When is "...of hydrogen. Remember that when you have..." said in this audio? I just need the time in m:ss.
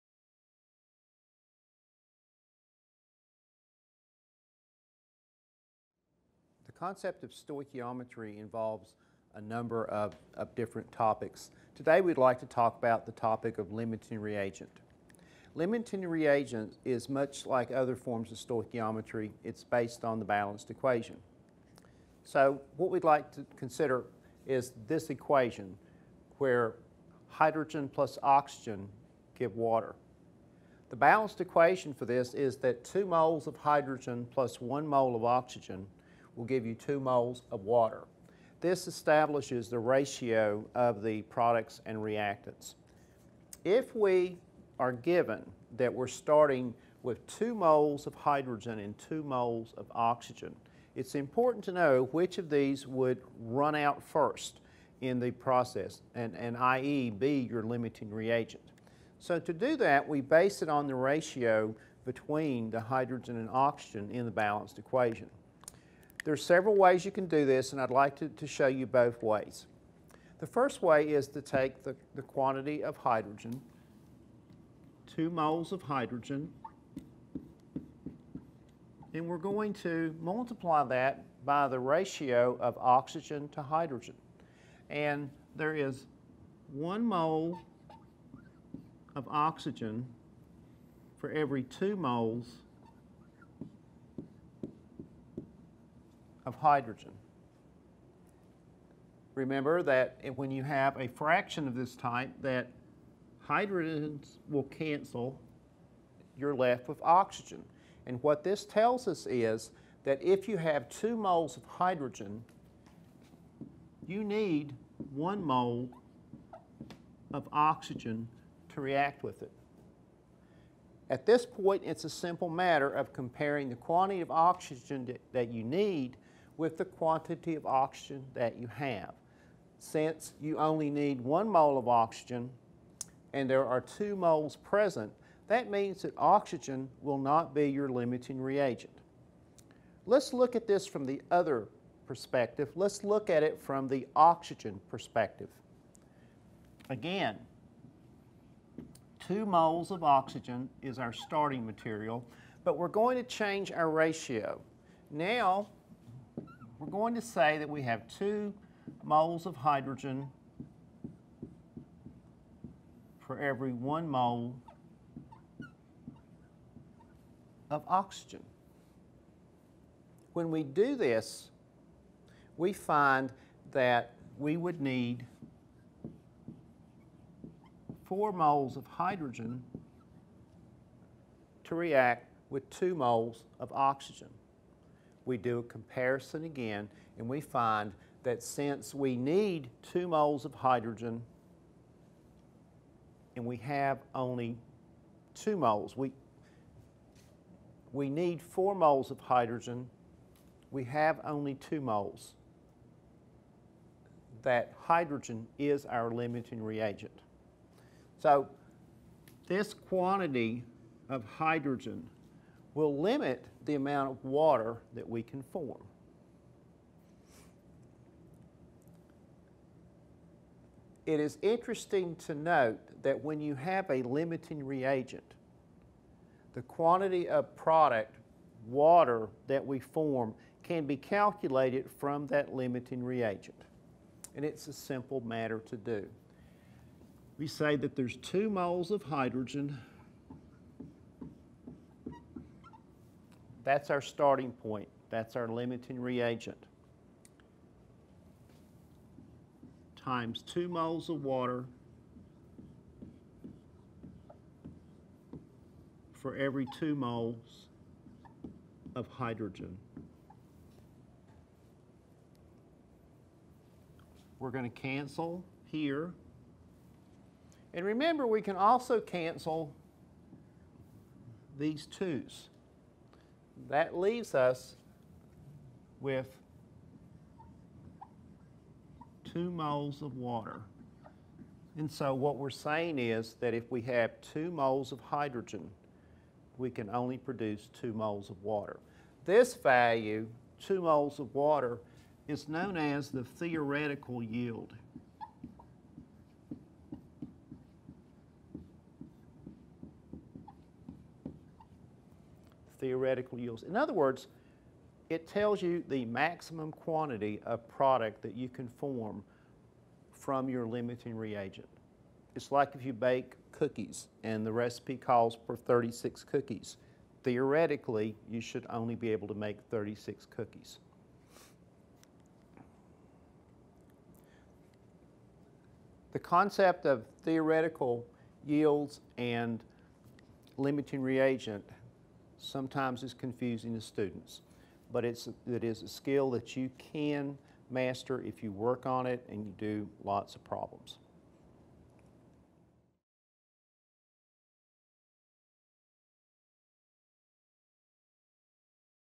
1:36.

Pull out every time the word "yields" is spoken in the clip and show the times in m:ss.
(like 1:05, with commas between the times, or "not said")
4:54, 5:03, 5:28.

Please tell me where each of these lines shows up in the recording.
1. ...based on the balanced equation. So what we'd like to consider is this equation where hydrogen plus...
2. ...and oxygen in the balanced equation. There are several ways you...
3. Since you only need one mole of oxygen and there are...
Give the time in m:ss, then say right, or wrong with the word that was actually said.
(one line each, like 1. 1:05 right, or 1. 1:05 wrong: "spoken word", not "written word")
1. 0:19 right
2. 1:03 right
3. 2:09 right.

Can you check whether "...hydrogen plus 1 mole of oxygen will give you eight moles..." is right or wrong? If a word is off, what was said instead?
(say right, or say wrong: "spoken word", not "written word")
wrong: "two", not "eight".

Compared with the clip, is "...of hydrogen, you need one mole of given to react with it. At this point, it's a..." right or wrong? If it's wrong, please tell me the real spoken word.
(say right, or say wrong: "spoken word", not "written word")
wrong: "oxygen", not "given".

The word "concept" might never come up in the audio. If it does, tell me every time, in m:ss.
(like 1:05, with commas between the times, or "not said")
0:06, 5:26.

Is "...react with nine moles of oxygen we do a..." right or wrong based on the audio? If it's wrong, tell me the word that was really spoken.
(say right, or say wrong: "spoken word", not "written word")
wrong: "two", not "nine".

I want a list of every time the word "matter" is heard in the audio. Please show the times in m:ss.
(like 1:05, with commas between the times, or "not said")
2:02, 3:55.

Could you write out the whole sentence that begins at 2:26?
Again, two moles of oxygen is our starting material, but we're going to change our ratio.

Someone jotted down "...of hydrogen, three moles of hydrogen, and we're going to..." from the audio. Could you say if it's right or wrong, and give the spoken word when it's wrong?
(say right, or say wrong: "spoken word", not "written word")
wrong: "two", not "three".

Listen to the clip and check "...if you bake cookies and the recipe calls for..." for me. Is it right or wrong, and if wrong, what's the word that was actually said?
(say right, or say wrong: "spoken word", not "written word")
right.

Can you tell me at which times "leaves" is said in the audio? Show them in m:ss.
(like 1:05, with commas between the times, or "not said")
4:33.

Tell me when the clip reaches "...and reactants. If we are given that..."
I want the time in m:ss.
0:41.